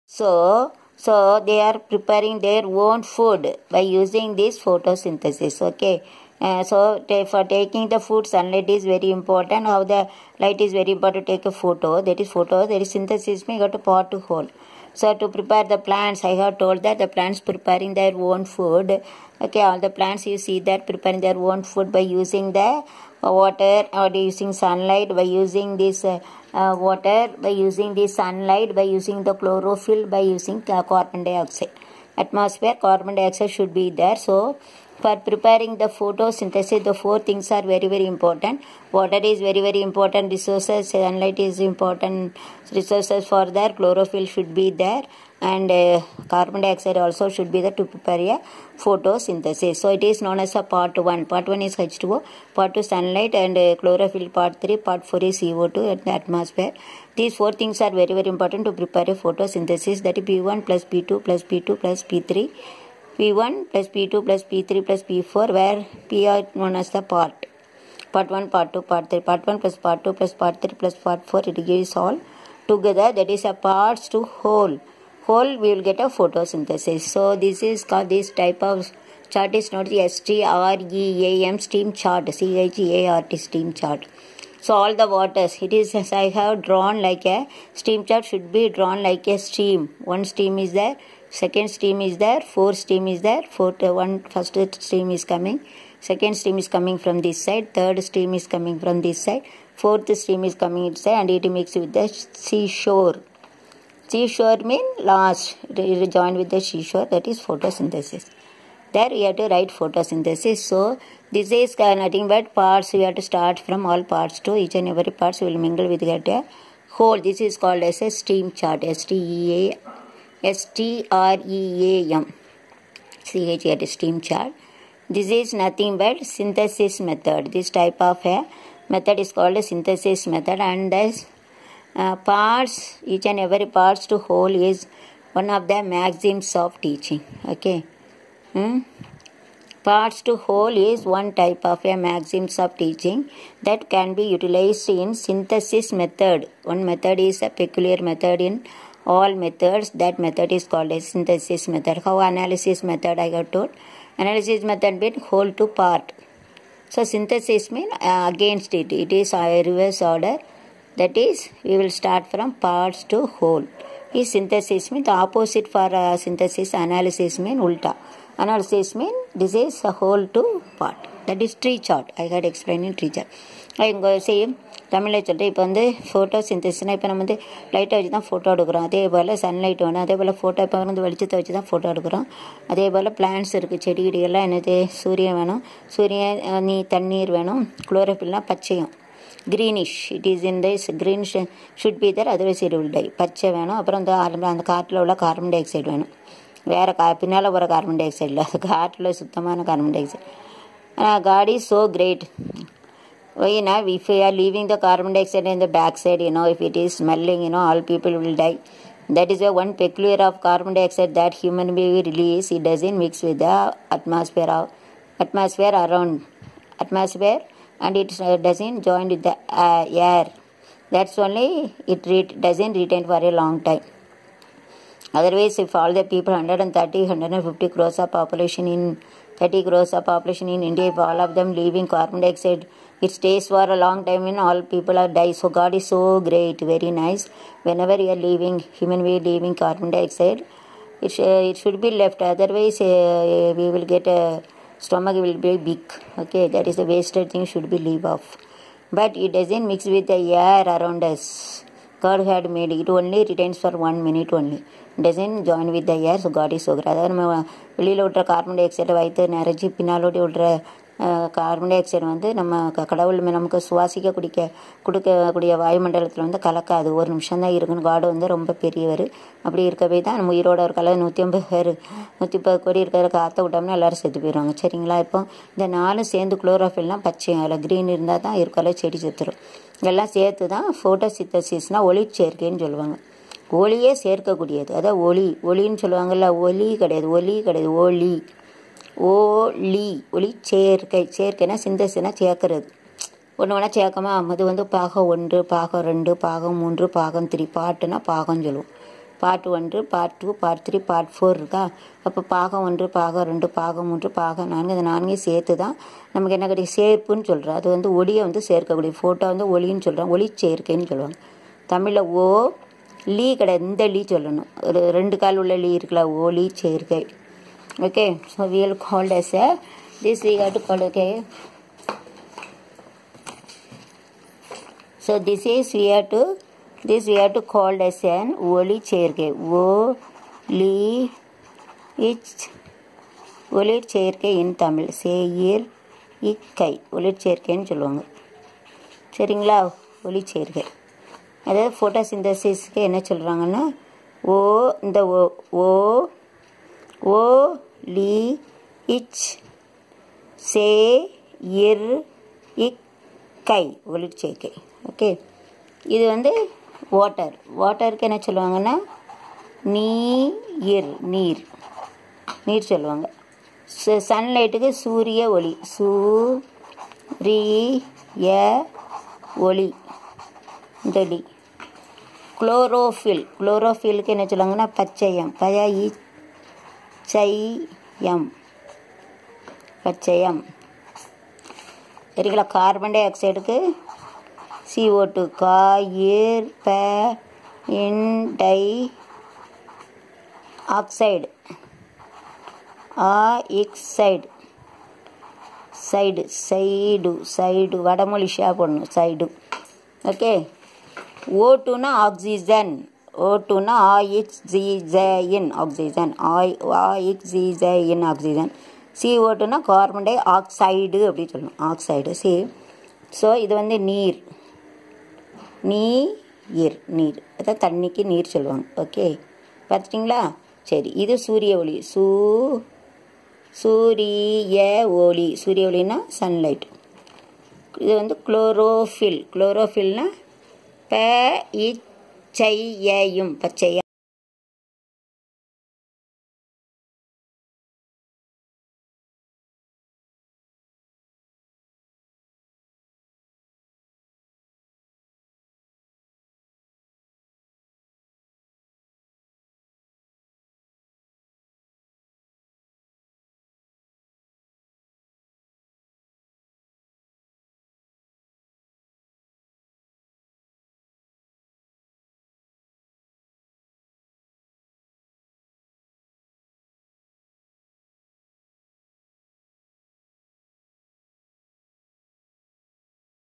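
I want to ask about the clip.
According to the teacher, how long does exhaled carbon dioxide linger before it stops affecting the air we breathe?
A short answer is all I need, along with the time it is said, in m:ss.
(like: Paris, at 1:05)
one minute, at 4:13.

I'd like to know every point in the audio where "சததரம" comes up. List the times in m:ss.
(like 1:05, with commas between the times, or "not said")
4:39.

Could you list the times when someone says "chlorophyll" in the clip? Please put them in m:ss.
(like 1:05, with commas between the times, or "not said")
0:29, 0:43, 0:53.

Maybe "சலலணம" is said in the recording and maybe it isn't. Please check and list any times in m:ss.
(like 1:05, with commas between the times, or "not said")
5:14, 6:51.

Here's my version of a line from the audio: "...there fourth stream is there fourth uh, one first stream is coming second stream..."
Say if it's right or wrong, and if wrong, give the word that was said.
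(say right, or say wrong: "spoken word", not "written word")
right.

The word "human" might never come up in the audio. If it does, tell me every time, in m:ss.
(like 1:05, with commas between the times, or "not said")
3:31, 3:58.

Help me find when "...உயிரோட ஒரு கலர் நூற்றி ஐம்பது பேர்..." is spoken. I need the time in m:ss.
4:30.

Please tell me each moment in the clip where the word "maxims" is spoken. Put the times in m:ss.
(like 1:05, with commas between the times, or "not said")
2:15, 2:21.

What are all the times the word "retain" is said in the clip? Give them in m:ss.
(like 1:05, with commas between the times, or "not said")
3:42, 4:13.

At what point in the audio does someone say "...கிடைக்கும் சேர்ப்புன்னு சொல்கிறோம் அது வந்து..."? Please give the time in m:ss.
5:06.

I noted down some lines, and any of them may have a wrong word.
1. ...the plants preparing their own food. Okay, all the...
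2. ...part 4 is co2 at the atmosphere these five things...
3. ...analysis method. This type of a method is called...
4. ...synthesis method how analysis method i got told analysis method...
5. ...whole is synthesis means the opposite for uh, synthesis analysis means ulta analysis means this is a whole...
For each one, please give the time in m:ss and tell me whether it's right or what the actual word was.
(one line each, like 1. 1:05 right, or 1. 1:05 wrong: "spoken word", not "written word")
1. 0:16 right
2. 0:54 wrong: "four", not "five"
3. 2:06 wrong: "synthesis", not "analysis"
4. 2:31 right
5. 2:43 right.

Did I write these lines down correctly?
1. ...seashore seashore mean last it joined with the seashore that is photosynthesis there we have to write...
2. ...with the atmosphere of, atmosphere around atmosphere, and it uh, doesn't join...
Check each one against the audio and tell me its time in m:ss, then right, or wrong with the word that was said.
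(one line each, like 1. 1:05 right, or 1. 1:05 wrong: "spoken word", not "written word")
1. 1:42 right
2. 3:33 right.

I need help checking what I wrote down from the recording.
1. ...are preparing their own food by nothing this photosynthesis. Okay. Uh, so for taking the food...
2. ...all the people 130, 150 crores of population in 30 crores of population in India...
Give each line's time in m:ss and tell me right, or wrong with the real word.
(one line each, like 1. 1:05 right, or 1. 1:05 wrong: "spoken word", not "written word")
1. 0:01 wrong: "using", not "nothing"
2. 3:45 right.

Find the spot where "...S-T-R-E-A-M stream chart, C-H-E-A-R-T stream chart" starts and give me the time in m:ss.
1:20.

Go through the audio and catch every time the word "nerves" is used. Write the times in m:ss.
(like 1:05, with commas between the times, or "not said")
not said.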